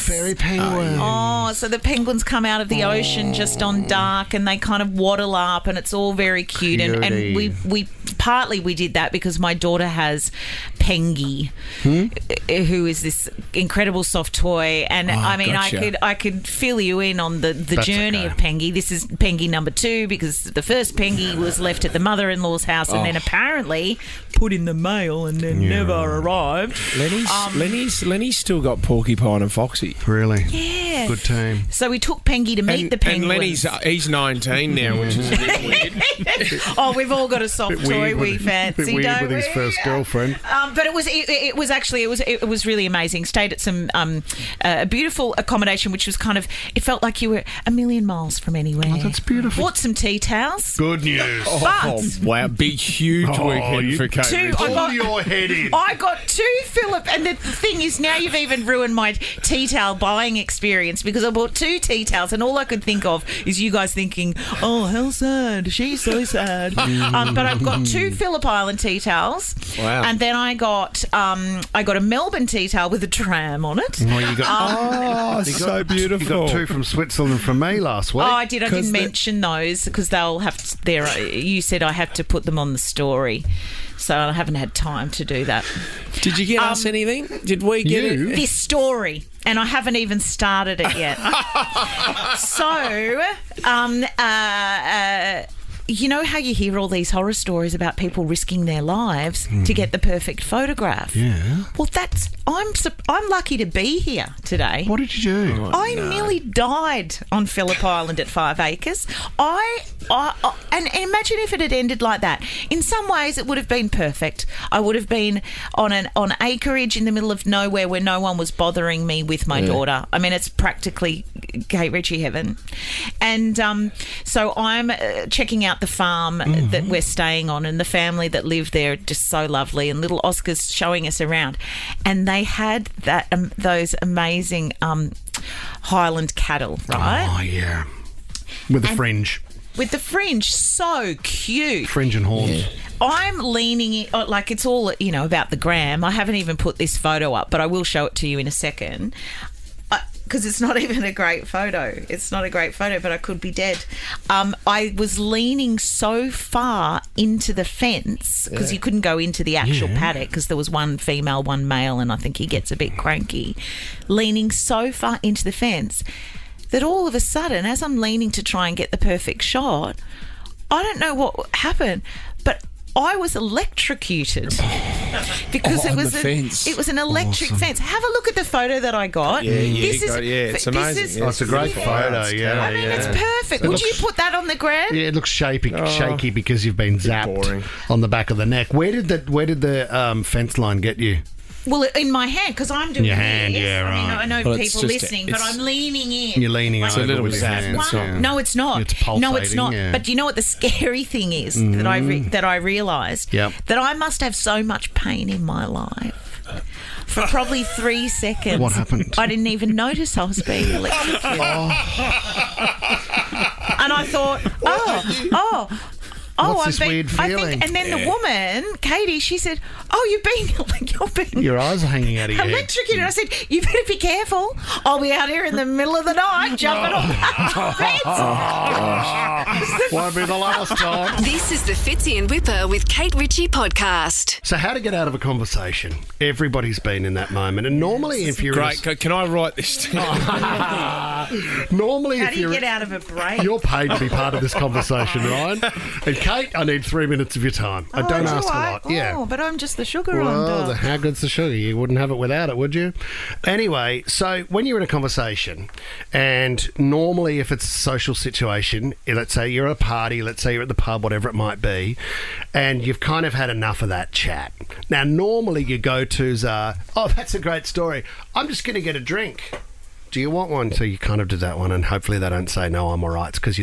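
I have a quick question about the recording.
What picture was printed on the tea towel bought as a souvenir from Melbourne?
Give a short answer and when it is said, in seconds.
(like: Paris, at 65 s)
A tram, at 73 s.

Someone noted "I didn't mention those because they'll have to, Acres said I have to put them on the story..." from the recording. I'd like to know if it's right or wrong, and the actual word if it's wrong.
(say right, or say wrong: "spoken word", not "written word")
wrong: "You", not "Acres".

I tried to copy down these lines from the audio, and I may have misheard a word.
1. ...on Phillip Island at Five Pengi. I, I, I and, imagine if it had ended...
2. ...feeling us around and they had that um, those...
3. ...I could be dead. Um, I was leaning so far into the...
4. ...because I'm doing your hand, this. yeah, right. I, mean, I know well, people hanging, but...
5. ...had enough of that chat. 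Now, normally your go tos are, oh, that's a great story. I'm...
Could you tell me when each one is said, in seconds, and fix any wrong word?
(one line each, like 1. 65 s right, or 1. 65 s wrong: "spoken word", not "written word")
1. 107 s wrong: "Acres", not "Pengi"
2. 130 s wrong: "showing", not "feeling"
3. 153 s right
4. 192 s wrong: "listening", not "hanging"
5. 263 s right.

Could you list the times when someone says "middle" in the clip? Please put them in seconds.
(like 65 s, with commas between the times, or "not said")
117 s, 225 s.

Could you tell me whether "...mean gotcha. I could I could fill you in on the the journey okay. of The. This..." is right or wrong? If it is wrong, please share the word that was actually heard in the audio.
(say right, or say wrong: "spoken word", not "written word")
wrong: "Pengi", not "The".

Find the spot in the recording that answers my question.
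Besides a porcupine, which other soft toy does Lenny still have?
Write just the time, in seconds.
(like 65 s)
29 s.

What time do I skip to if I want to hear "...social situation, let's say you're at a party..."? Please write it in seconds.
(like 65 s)
257 s.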